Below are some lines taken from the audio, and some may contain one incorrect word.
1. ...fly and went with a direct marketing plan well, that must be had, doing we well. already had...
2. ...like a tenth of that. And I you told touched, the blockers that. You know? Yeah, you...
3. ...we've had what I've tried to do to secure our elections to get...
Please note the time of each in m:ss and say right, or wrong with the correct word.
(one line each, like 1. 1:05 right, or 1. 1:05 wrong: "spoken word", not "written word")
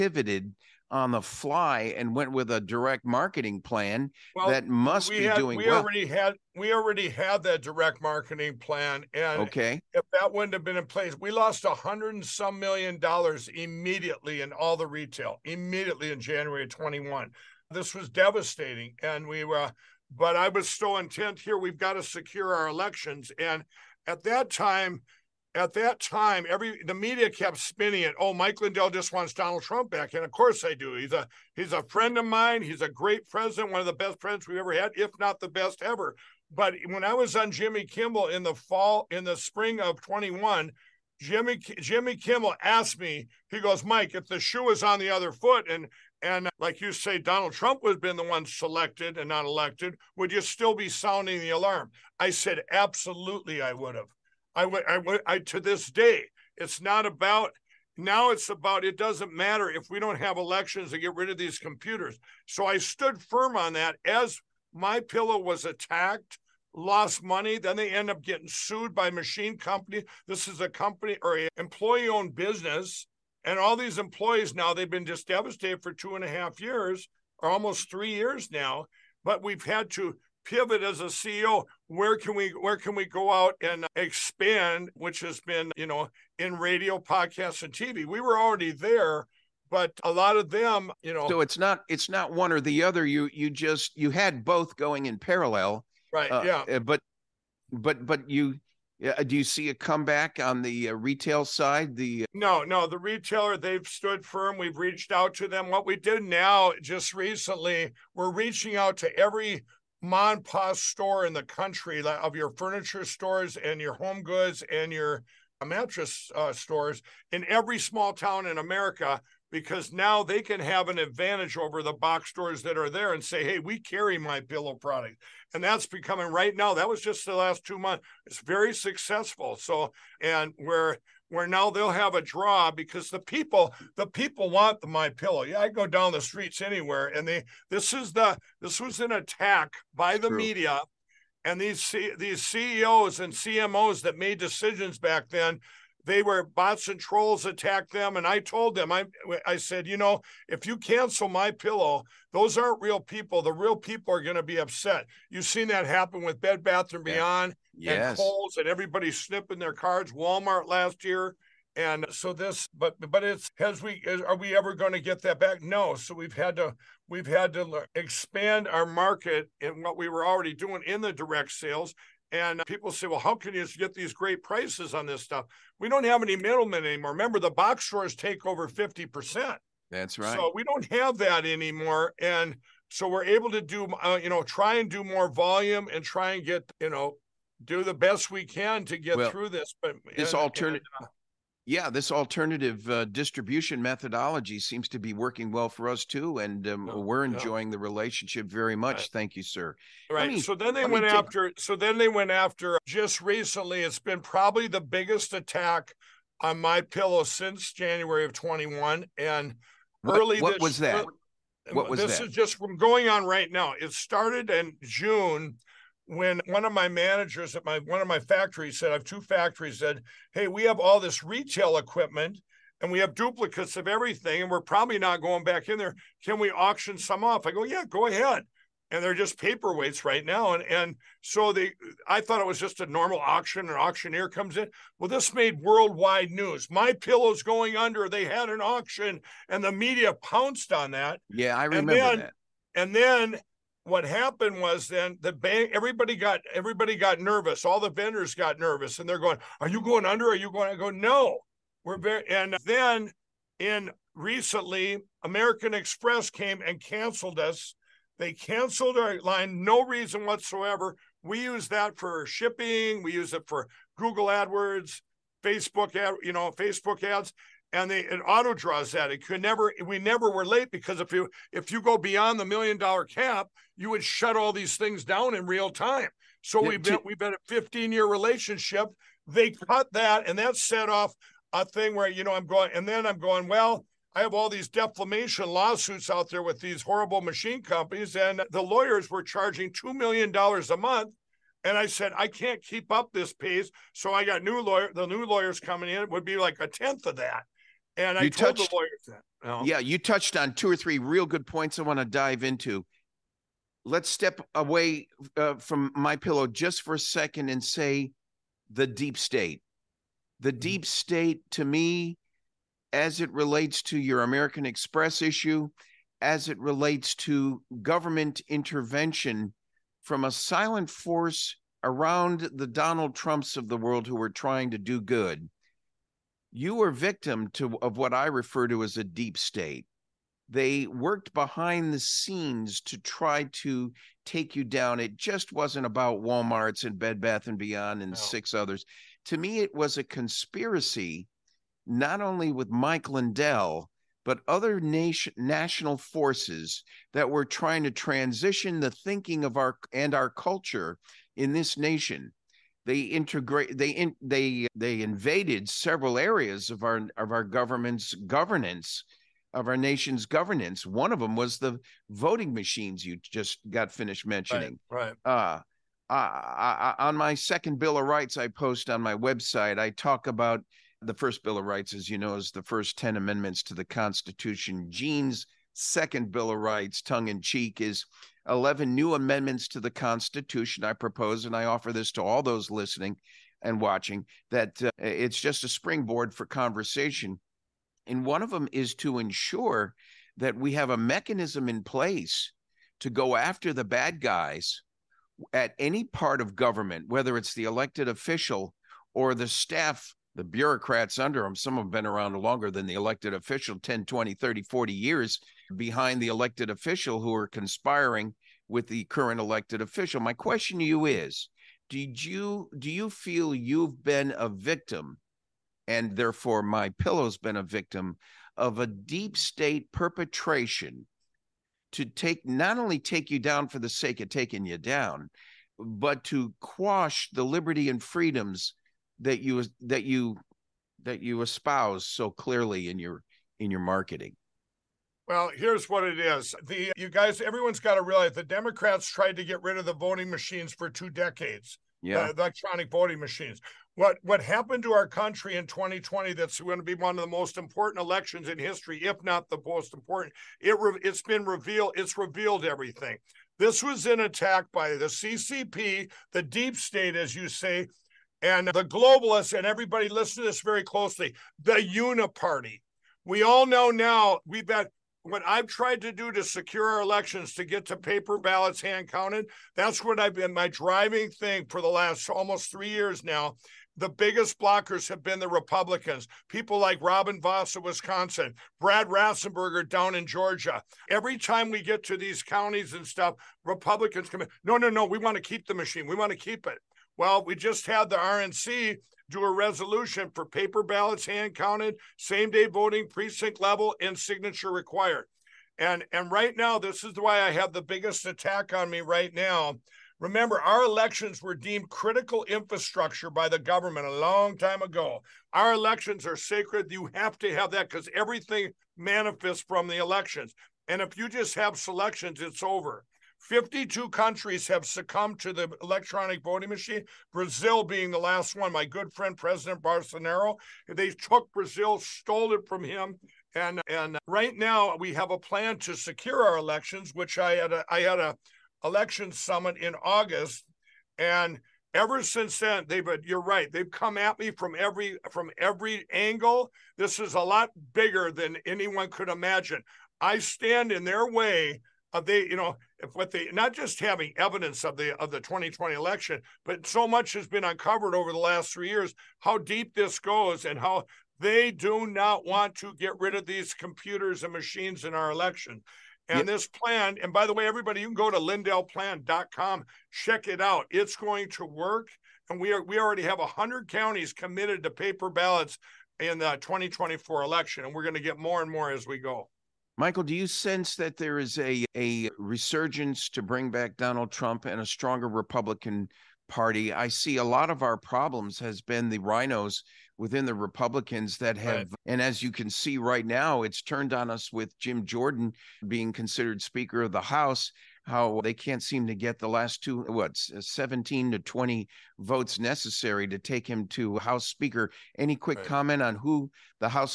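1. 0:01 right
2. 4:56 wrong: "lawyers", not "blockers"
3. 7:44 right.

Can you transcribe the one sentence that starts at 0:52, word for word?
I said, absolutely, I would have.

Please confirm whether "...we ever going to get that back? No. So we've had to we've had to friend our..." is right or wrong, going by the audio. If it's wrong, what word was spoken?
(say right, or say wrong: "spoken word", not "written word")
wrong: "expand", not "friend".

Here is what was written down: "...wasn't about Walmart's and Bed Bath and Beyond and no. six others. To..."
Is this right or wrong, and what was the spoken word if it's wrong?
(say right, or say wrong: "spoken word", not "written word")
right.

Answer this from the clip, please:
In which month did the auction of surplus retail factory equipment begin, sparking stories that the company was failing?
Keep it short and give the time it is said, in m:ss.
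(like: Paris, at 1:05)
June, at 3:34.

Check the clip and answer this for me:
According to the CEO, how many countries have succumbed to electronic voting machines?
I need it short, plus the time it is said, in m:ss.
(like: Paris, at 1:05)
52, at 8:33.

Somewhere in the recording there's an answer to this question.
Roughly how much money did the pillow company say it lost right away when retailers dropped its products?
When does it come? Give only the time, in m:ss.
0:11.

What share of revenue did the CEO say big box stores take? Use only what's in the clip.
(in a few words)
over 50%.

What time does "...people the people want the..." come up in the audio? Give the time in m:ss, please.
2:13.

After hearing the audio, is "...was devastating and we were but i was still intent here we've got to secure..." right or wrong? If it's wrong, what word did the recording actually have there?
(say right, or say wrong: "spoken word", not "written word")
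right.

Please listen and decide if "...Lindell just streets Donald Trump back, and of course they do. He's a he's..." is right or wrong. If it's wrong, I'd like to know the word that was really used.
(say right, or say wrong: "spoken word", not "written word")
wrong: "wants", not "streets".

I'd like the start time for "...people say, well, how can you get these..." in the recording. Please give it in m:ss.
2:52.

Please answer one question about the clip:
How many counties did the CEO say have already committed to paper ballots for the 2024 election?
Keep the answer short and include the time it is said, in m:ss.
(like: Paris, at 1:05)
100, at 9:23.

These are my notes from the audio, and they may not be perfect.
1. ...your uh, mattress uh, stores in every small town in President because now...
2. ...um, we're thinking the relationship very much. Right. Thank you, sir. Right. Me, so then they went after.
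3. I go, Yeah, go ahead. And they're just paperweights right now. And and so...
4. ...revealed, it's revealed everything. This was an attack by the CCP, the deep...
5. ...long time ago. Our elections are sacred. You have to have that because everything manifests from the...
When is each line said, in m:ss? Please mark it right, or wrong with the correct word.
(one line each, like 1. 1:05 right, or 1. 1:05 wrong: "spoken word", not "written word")
1. 1:54 wrong: "America", not "President"
2. 3:16 wrong: "enjoying", not "thinking"
3. 3:47 right
4. 7:31 right
5. 8:24 right.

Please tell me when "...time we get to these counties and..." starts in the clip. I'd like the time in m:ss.
8:01.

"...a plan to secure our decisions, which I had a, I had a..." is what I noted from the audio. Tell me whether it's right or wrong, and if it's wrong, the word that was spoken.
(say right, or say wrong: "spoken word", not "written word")
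wrong: "elections", not "decisions".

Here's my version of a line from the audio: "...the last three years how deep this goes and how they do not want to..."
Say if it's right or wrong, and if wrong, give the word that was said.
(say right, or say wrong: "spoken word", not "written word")
right.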